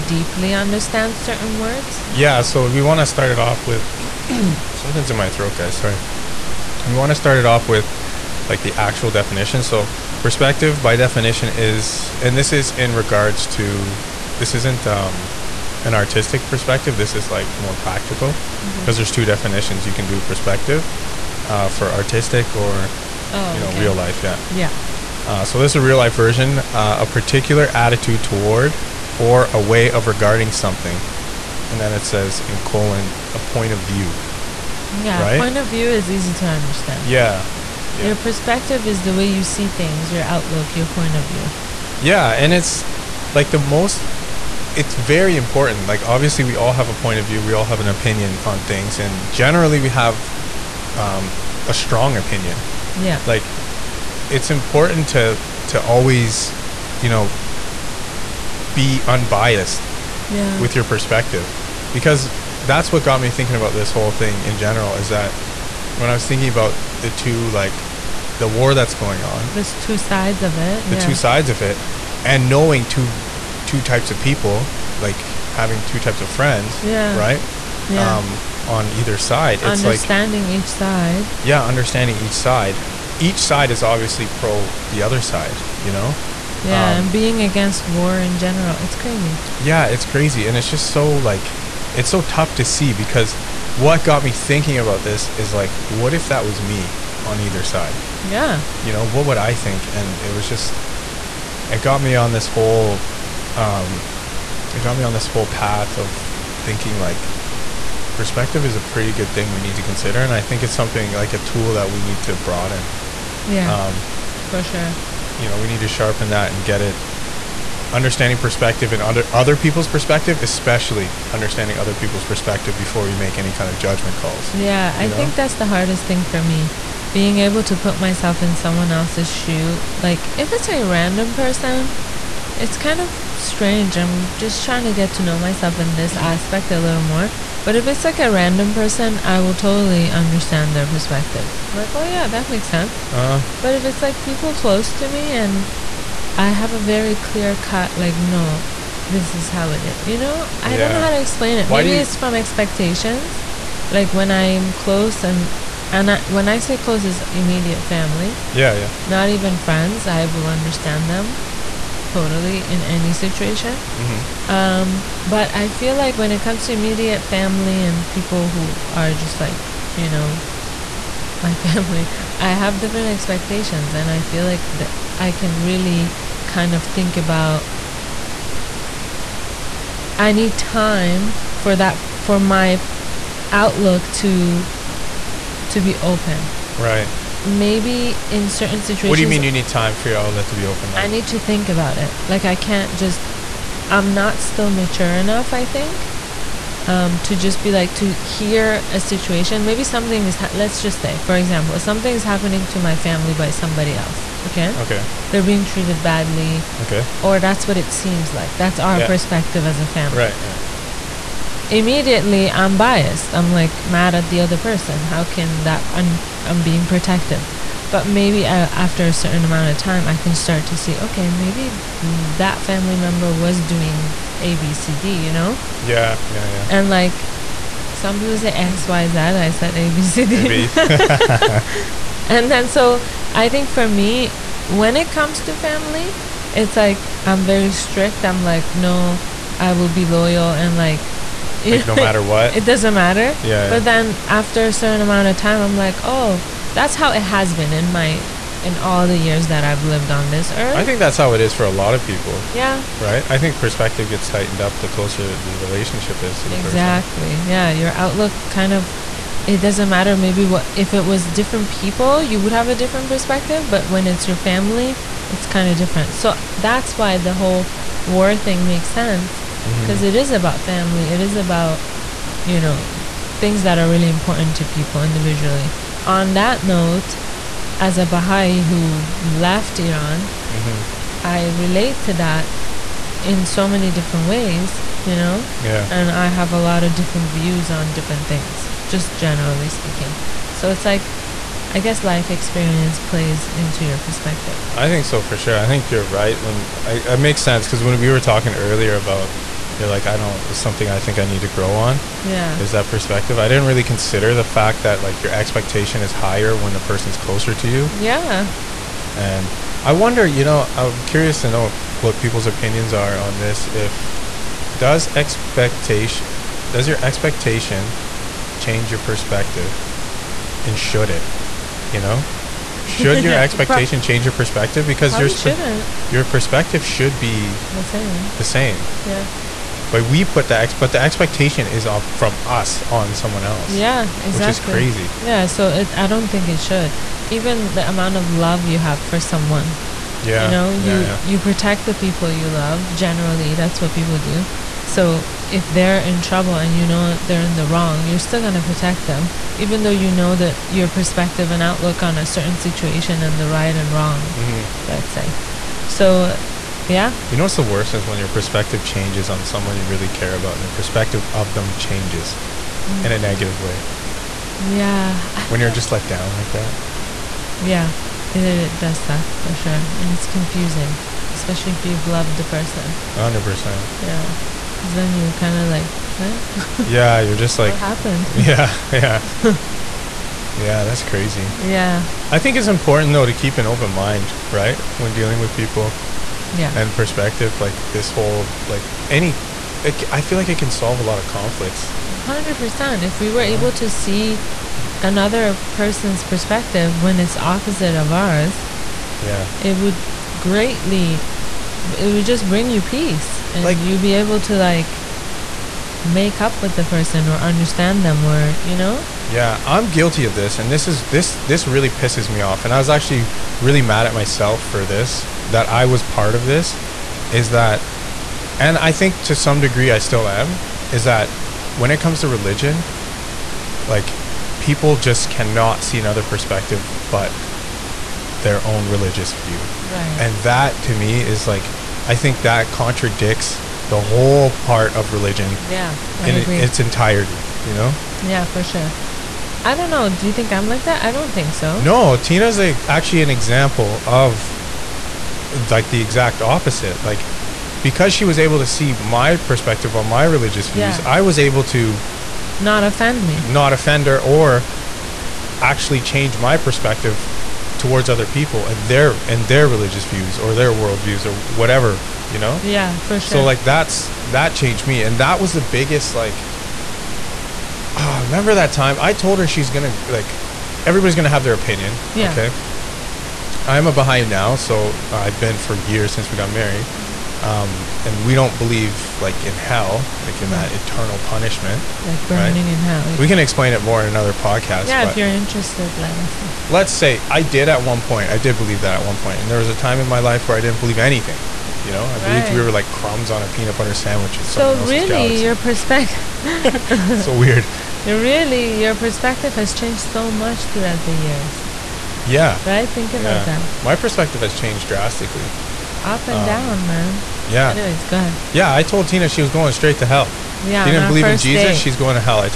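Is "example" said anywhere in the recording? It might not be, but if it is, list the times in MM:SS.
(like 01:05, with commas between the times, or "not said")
03:21, 07:23.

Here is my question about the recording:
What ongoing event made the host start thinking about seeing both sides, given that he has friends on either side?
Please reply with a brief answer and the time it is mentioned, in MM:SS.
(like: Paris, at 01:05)
the war, at 01:08.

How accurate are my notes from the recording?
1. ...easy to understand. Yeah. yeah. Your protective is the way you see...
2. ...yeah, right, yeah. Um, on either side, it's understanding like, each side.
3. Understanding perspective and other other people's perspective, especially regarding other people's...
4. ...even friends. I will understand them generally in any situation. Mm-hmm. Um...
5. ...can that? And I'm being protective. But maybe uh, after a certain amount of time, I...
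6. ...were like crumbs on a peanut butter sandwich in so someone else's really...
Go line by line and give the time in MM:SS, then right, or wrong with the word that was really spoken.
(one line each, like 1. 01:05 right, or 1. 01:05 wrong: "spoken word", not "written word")
1. 00:36 wrong: "perspective", not "protective"
2. 01:16 right
3. 01:57 wrong: "understanding", not "regarding"
4. 02:39 wrong: "totally", not "generally"
5. 03:35 right
6. 08:12 right.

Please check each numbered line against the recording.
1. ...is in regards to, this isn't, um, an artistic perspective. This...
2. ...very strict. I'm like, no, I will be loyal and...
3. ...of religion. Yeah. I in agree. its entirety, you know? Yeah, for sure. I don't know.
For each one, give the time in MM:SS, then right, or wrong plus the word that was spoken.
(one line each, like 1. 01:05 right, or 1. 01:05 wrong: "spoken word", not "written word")
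1. 00:12 right
2. 03:57 right
3. 07:14 right.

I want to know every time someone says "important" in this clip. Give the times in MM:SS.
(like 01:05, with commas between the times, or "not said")
00:45, 00:54, 04:34, 06:22.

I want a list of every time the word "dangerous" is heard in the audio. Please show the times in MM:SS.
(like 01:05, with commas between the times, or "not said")
not said.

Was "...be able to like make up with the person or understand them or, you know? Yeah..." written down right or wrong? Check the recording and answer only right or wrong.
right.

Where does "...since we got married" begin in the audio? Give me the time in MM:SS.
07:56.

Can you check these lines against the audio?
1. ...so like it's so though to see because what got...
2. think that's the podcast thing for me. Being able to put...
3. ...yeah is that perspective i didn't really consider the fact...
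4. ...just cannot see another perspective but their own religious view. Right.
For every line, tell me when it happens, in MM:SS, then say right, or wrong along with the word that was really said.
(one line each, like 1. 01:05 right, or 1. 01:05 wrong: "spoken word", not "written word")
1. 01:30 wrong: "tough", not "though"
2. 02:05 wrong: "hardest", not "podcast"
3. 05:02 right
4. 07:04 right.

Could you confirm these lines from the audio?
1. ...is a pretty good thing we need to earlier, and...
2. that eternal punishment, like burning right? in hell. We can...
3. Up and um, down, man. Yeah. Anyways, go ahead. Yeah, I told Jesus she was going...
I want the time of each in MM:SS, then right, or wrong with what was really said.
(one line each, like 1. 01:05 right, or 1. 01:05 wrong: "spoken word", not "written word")
1. 01:48 wrong: "consider", not "earlier"
2. 08:00 right
3. 08:26 wrong: "Tina", not "Jesus".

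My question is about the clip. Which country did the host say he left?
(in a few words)
Iran.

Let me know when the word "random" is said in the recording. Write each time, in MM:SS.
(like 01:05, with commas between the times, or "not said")
02:10, 02:18.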